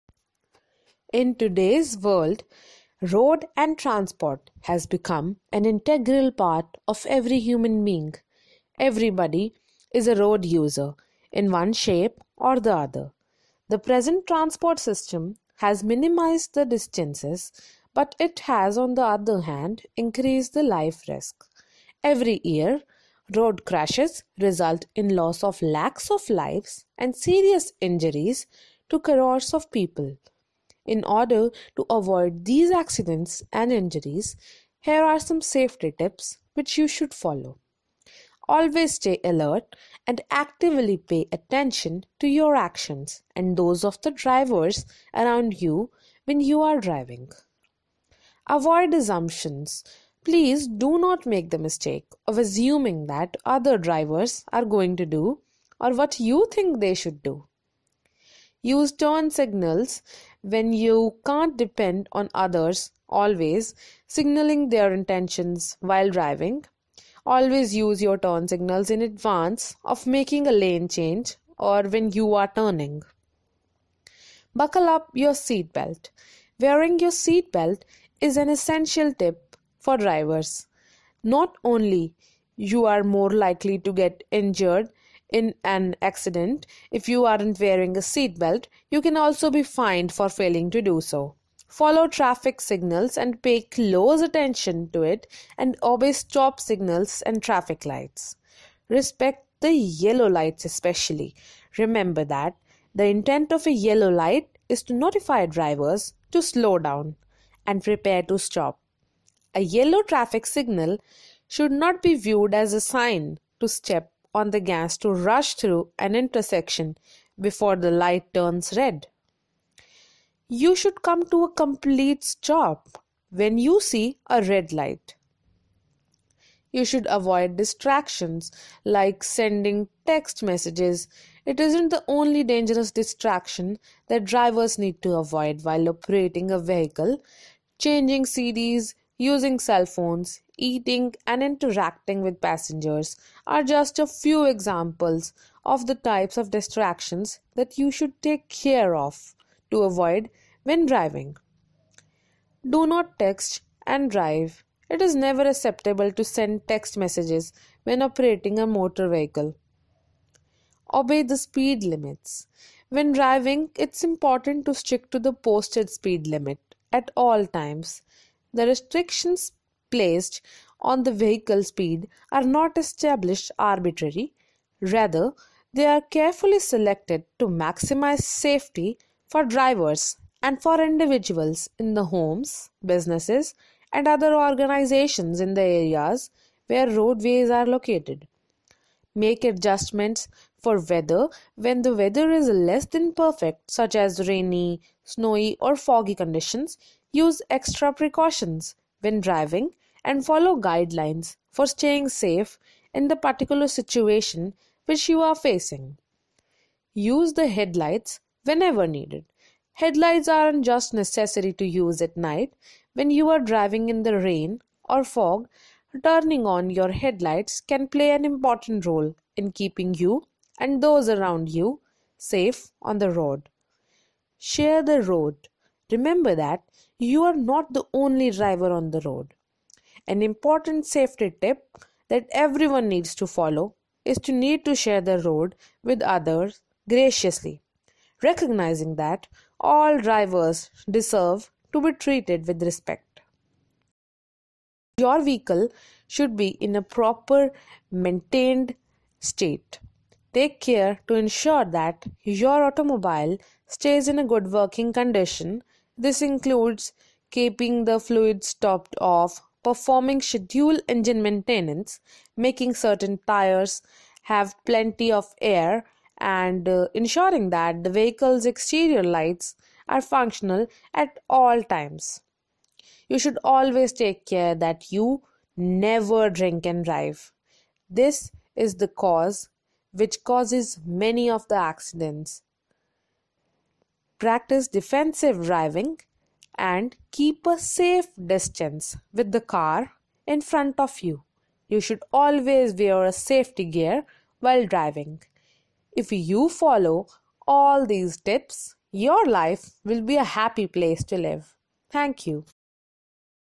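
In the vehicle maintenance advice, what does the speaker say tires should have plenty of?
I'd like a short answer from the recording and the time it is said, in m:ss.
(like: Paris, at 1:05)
air, at 4:25.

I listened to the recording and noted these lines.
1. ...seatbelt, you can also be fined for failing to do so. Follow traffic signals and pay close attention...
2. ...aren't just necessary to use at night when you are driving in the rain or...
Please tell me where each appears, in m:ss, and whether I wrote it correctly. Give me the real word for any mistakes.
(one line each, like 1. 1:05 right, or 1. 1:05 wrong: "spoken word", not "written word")
1. 1:28 right
2. 3:30 right.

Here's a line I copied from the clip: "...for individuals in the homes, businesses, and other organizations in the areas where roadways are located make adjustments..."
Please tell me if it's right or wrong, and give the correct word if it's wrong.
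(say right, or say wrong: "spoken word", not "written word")
right.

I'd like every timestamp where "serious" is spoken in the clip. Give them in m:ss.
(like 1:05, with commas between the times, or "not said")
0:27.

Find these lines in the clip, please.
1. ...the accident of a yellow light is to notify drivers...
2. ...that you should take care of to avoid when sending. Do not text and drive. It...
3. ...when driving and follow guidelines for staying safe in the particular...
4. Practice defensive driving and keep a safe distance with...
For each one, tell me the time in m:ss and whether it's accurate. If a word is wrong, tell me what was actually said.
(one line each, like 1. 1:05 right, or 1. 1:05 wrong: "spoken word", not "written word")
1. 1:42 wrong: "intent", not "accident"
2. 2:27 wrong: "driving", not "sending"
3. 3:19 right
4. 4:44 right.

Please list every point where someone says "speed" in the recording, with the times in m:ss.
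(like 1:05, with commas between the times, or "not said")
2:41, 2:45, 2:51.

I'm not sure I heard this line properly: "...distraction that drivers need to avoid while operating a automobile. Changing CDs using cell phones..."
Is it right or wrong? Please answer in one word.
wrong.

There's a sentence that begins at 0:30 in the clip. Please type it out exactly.
In order to avoid these accidents and injuries, here are some safety tips which you should follow.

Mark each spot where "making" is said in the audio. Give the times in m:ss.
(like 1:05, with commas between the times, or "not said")
1:10, 4:22.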